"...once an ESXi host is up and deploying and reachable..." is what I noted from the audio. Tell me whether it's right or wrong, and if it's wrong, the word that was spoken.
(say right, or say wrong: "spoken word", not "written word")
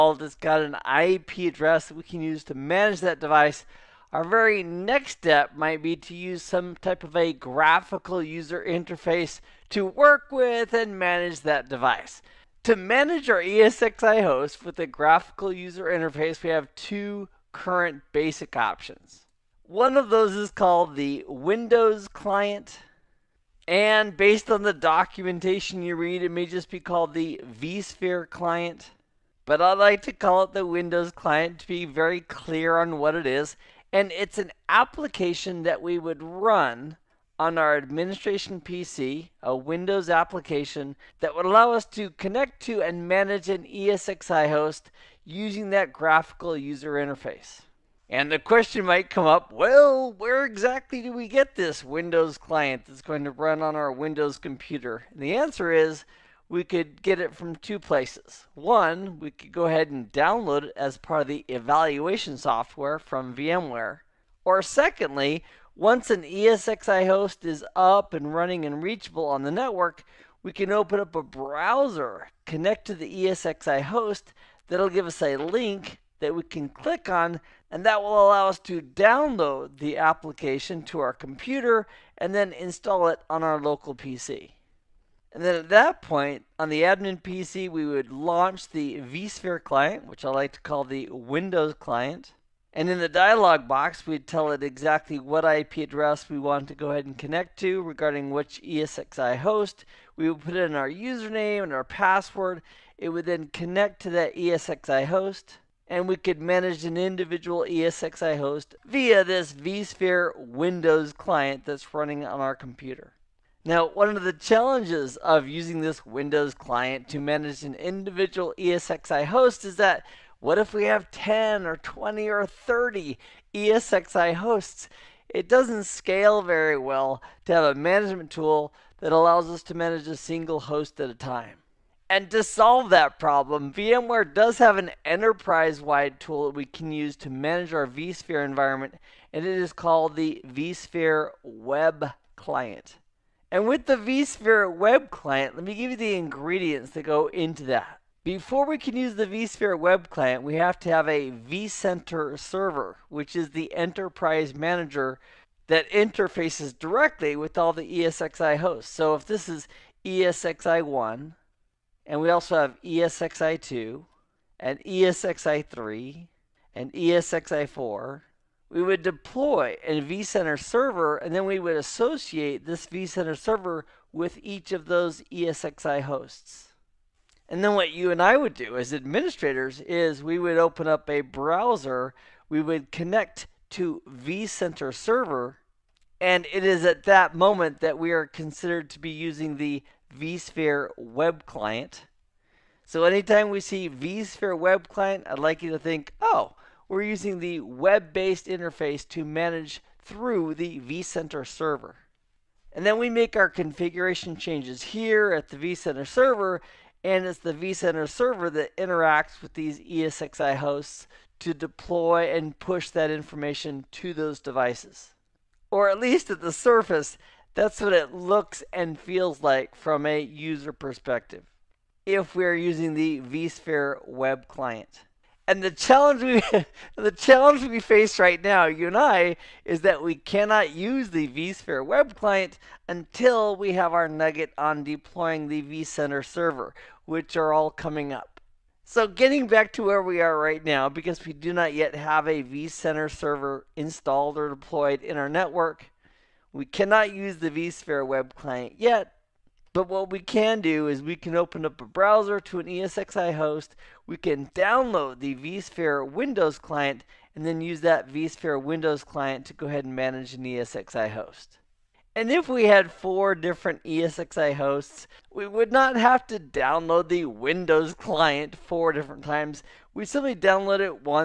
wrong: "running", not "deploying".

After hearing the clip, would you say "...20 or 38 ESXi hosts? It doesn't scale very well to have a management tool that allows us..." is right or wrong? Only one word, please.
wrong.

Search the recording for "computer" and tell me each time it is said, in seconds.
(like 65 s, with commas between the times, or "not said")
54 s, 81 s, 112 s.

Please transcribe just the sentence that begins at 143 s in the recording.
And with the vSphere Web Client, let me give you the ingredients that go into that.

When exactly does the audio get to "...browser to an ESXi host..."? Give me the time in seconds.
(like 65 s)
251 s.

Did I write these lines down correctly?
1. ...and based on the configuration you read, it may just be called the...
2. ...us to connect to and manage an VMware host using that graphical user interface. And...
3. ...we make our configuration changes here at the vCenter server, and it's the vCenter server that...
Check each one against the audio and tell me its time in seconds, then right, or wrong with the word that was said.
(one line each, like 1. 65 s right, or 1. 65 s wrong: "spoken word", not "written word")
1. 23 s wrong: "documentation", not "configuration"
2. 41 s wrong: "ESXi", not "VMware"
3. 202 s right.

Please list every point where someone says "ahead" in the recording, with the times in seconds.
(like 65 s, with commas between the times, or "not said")
59 s, 96 s, 259 s.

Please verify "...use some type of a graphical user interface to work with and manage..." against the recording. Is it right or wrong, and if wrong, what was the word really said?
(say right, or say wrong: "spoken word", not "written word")
right.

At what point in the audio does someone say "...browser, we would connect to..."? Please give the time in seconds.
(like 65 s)
181 s.